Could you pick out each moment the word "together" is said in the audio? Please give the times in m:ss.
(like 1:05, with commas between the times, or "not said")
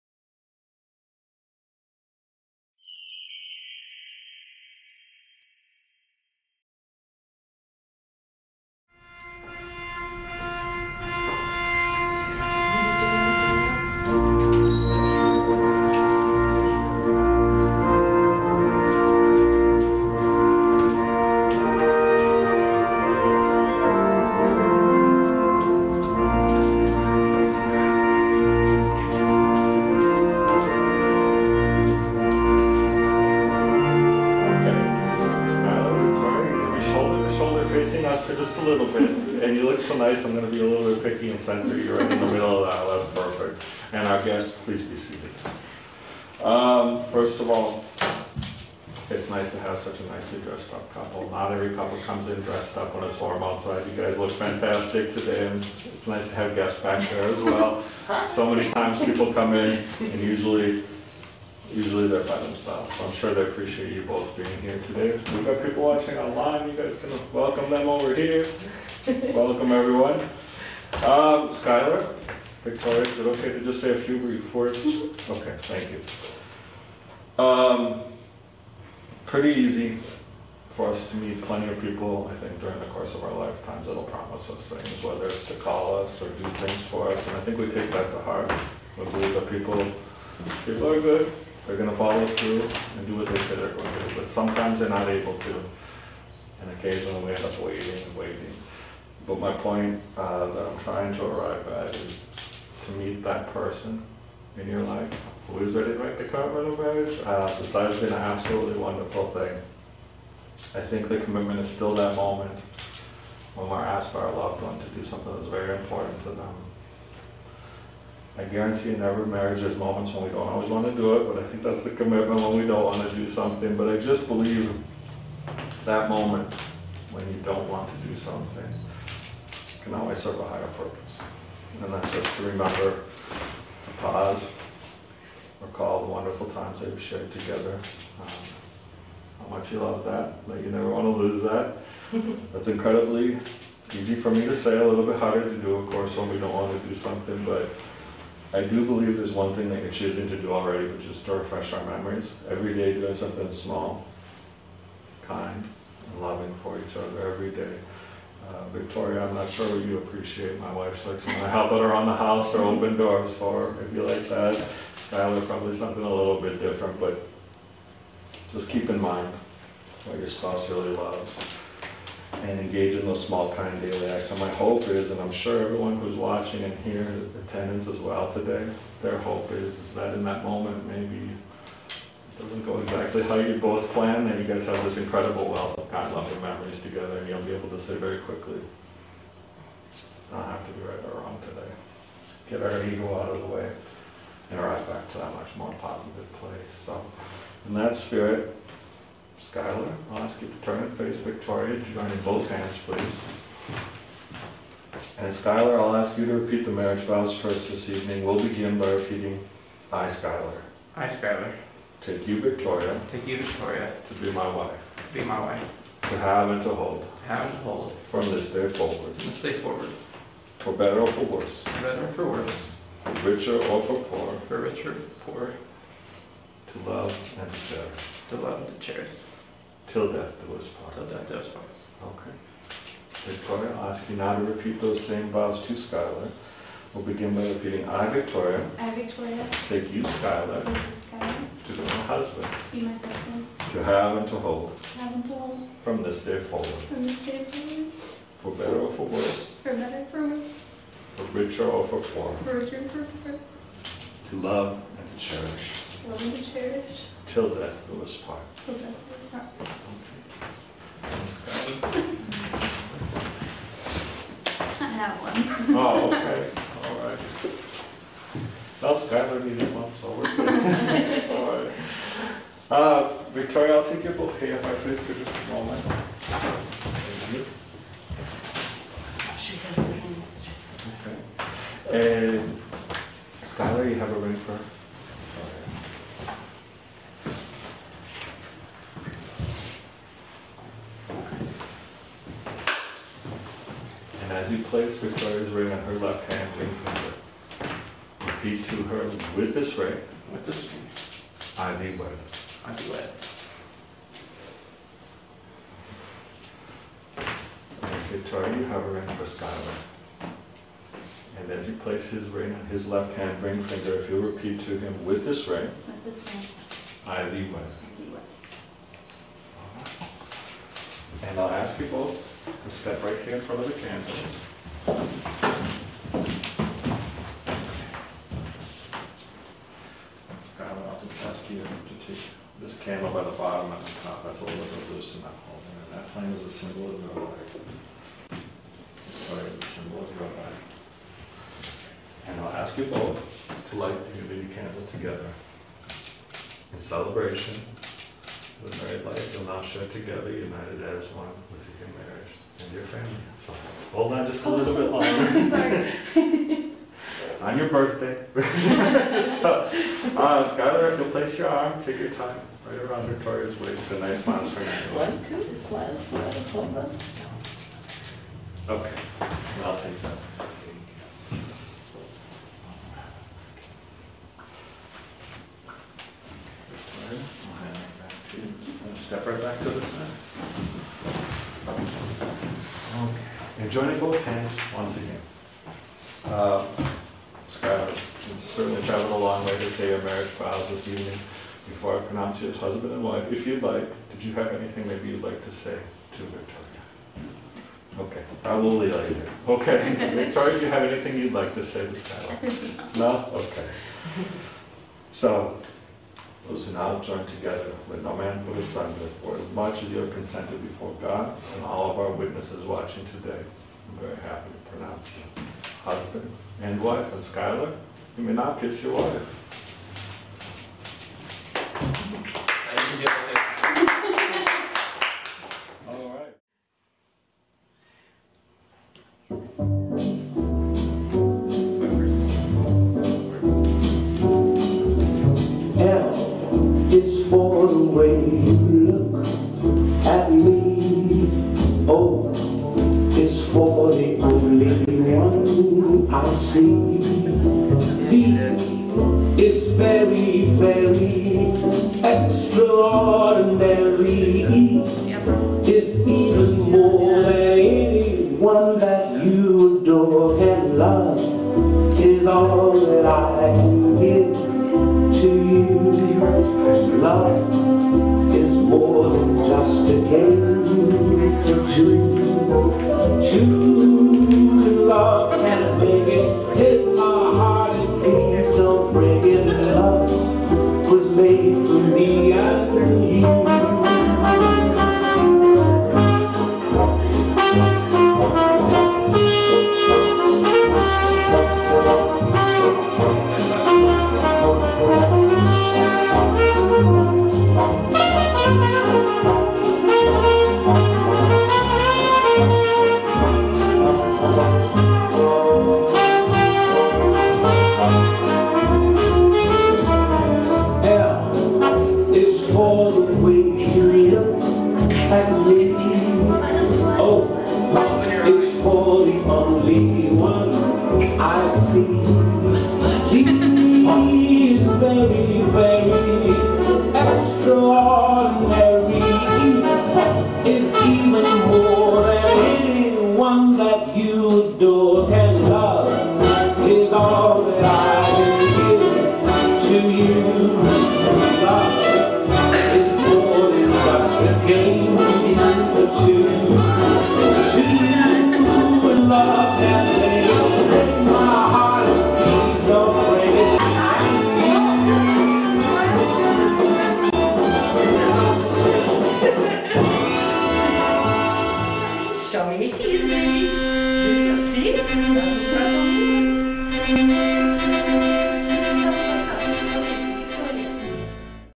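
2:17, 3:06, 5:44, 5:49, 6:47.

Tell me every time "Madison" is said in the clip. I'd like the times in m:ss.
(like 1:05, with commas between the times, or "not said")
not said.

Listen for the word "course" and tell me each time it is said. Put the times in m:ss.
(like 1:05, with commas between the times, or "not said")
1:22, 2:25.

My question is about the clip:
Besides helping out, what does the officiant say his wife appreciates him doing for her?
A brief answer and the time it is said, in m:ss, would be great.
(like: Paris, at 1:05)
Open doors for her, at 2:42.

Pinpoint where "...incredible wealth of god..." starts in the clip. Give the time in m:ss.
3:04.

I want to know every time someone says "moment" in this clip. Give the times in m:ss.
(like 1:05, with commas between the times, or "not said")
1:52, 1:59, 2:06, 3:00, 4:35.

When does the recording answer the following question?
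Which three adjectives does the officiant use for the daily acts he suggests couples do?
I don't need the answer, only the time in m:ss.
2:33.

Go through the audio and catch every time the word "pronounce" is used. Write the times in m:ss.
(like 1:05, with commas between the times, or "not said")
6:32, 6:54.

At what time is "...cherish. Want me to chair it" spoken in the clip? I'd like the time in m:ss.
4:15.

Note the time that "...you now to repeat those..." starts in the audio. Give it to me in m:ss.
3:54.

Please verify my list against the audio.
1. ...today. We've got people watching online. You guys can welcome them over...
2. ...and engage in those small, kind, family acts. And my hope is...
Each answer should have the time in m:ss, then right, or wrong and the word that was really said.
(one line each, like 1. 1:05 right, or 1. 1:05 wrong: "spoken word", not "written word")
1. 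1:04 right
2. 2:52 wrong: "daily", not "family".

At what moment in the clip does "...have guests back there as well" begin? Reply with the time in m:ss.
0:56.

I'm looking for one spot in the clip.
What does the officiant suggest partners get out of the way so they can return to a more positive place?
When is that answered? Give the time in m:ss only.
3:12.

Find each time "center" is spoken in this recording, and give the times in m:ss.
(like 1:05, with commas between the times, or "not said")
0:41, 6:19.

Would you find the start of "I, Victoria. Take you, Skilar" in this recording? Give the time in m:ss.
3:58.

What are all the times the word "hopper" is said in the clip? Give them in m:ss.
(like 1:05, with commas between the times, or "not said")
not said.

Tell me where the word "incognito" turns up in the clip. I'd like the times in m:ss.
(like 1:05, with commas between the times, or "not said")
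not said.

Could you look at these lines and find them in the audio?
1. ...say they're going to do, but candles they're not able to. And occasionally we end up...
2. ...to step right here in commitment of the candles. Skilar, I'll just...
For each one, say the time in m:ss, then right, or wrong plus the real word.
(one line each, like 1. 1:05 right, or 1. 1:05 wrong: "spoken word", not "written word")
1. 1:33 wrong: "sometimes", not "candles"
2. 5:22 wrong: "front", not "commitment".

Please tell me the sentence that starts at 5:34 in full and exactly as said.
That's a little bit loose in that am holding That flame is a symbol of your life.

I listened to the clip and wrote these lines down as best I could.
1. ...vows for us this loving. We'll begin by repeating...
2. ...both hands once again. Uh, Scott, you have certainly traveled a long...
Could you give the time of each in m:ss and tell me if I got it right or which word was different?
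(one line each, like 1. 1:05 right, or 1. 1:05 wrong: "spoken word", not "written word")
1. 3:27 wrong: "evening", not "loving"
2. 6:23 right.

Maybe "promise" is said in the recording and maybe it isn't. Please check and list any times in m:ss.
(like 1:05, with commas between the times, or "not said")
1:24.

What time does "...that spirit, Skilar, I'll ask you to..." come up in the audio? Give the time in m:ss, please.
3:17.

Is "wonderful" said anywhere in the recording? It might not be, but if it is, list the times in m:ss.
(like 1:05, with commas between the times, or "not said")
1:48, 2:16.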